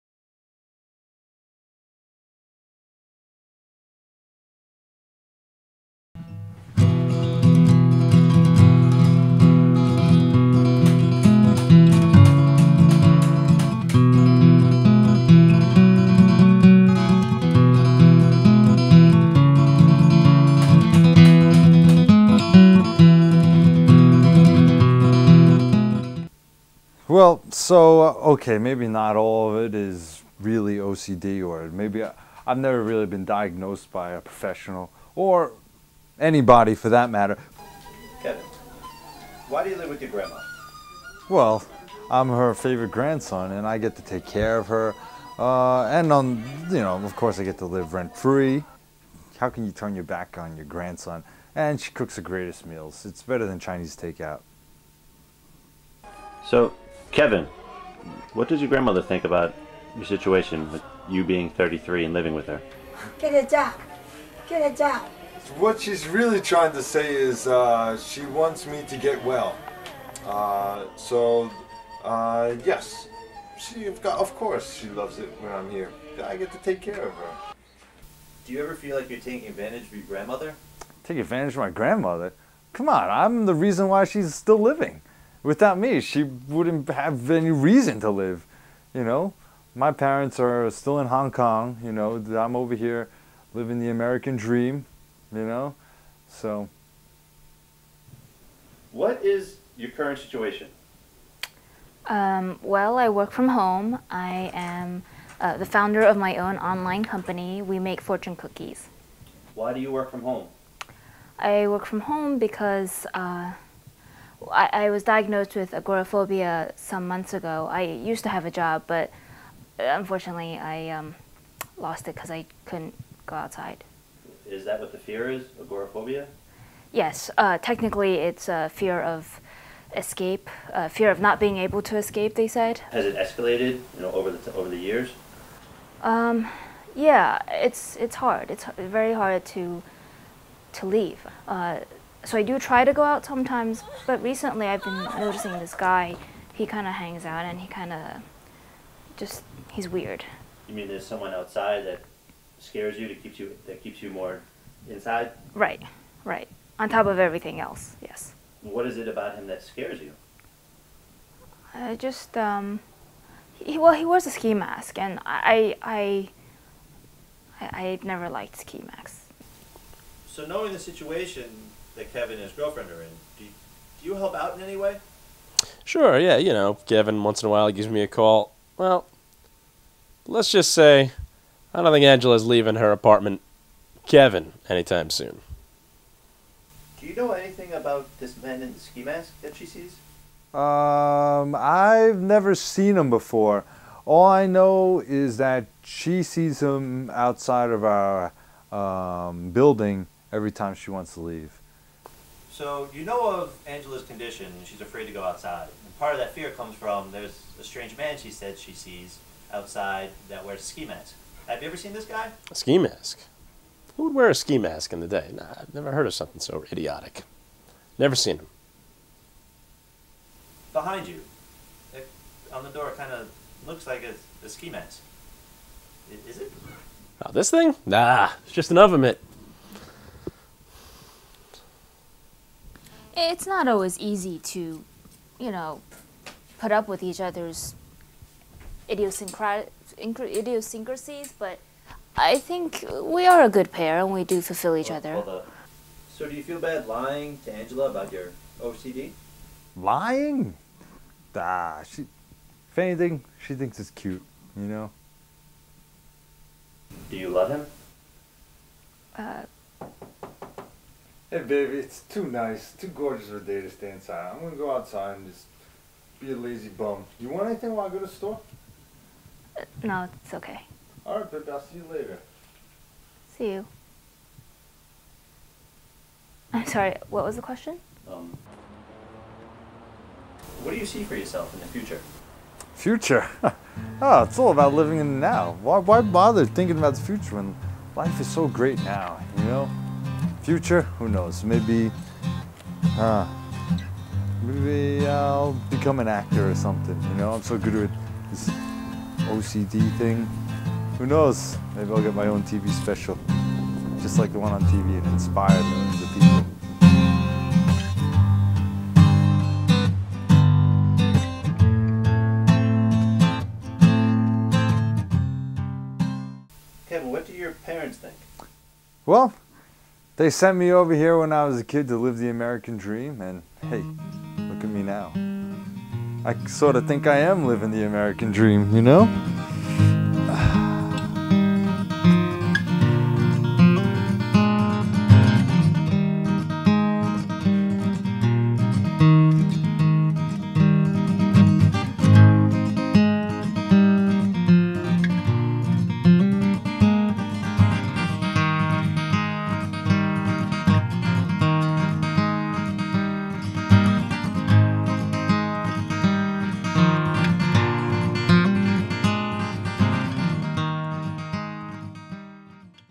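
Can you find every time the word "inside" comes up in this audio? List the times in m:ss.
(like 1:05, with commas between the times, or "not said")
2:34, 4:23.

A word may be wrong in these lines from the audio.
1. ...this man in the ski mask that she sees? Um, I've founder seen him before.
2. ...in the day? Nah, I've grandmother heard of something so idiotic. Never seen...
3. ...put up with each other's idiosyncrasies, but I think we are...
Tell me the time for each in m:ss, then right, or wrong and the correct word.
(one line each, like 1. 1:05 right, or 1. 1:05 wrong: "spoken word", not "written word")
1. 3:08 wrong: "never", not "founder"
2. 3:34 wrong: "never", not "grandmother"
3. 3:56 right.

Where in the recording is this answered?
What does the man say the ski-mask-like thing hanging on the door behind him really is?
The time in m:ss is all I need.
3:48.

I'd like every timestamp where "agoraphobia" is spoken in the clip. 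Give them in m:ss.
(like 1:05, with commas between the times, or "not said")
1:55, 2:05.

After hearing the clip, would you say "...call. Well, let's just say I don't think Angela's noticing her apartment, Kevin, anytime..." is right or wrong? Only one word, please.
wrong.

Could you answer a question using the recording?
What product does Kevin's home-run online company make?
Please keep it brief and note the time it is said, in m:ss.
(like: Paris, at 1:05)
Fortune cookies, at 1:48.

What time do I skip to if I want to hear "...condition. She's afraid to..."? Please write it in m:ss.
3:24.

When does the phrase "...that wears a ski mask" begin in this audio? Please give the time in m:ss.
3:30.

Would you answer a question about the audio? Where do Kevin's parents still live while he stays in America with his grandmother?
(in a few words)
Hong Kong.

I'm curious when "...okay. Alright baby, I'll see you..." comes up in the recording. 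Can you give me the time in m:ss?
4:30.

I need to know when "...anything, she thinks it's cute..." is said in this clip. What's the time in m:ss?
4:12.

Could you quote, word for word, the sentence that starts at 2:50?
So knowing the situation, that Kevin and his girlfriend are in.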